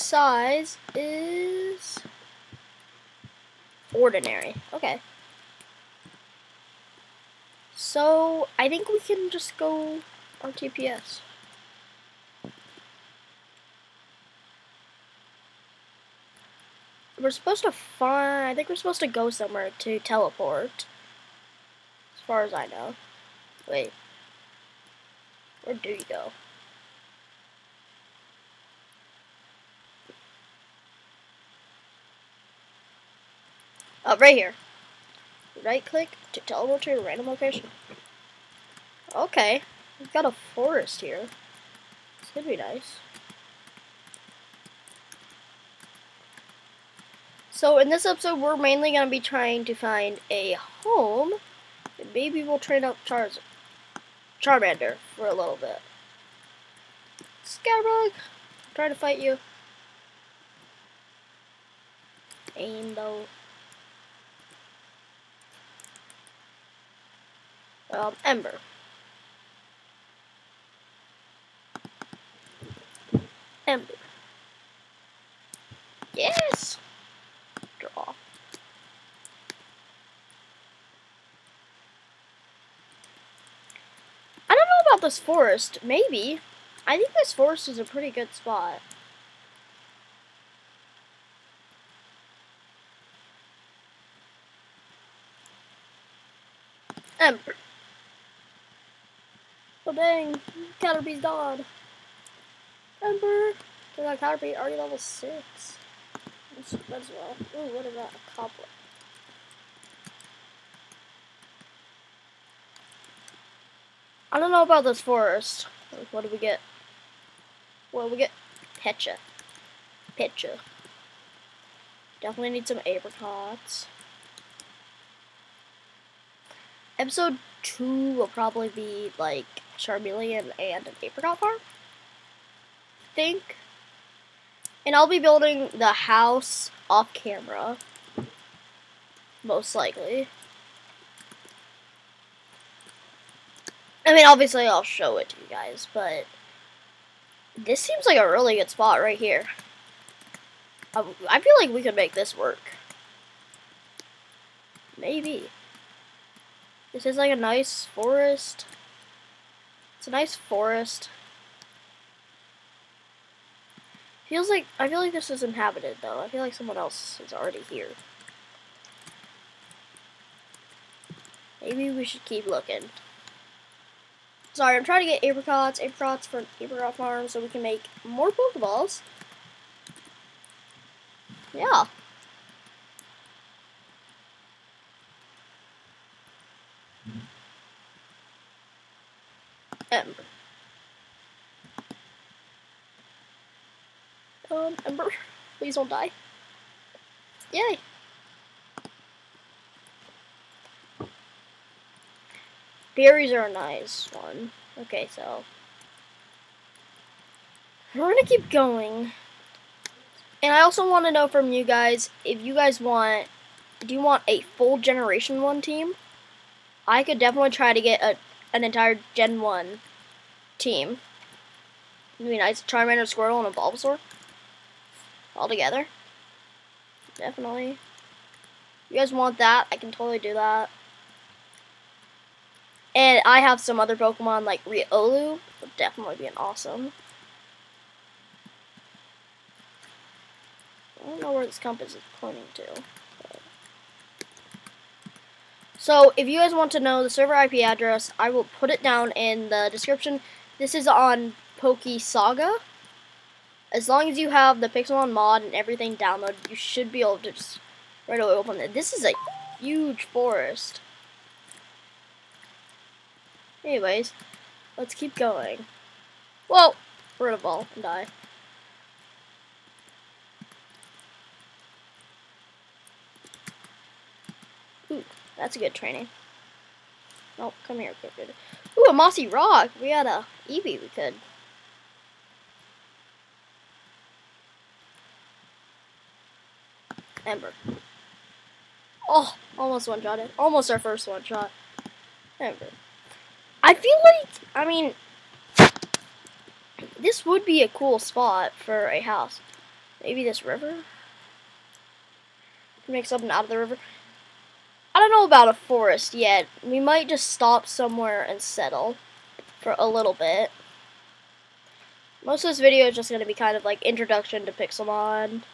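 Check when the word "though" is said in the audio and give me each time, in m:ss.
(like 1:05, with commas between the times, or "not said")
1:02, 2:46.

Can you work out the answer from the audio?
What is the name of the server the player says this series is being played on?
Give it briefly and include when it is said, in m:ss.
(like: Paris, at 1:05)
Poke Saga, at 4:11.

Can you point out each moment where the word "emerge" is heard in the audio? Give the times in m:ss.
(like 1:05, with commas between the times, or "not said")
not said.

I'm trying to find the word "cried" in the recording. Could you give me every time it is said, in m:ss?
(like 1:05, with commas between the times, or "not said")
not said.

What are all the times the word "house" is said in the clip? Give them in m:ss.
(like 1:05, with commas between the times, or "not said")
2:15, 4:59.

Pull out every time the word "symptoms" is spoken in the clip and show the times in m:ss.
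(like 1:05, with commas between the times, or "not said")
not said.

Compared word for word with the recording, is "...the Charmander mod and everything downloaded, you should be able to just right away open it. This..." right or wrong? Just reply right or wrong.
wrong.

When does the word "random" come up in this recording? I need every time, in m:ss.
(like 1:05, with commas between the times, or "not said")
0:37.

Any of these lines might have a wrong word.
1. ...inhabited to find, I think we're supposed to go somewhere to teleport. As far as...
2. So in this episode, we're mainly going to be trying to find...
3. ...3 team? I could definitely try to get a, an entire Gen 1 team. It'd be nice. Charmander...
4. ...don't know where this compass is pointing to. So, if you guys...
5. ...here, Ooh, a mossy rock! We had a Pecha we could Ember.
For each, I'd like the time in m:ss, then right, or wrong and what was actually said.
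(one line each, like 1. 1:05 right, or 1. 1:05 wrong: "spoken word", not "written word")
1. 0:17 wrong: "supposed", not "inhabited"
2. 0:47 right
3. 3:35 wrong: "1", not "3"
4. 4:01 right
5. 4:37 wrong: "Eevee", not "Pecha".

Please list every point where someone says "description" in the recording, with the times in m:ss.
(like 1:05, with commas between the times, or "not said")
4:09.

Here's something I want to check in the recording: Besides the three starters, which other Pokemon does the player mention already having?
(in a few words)
Riolu.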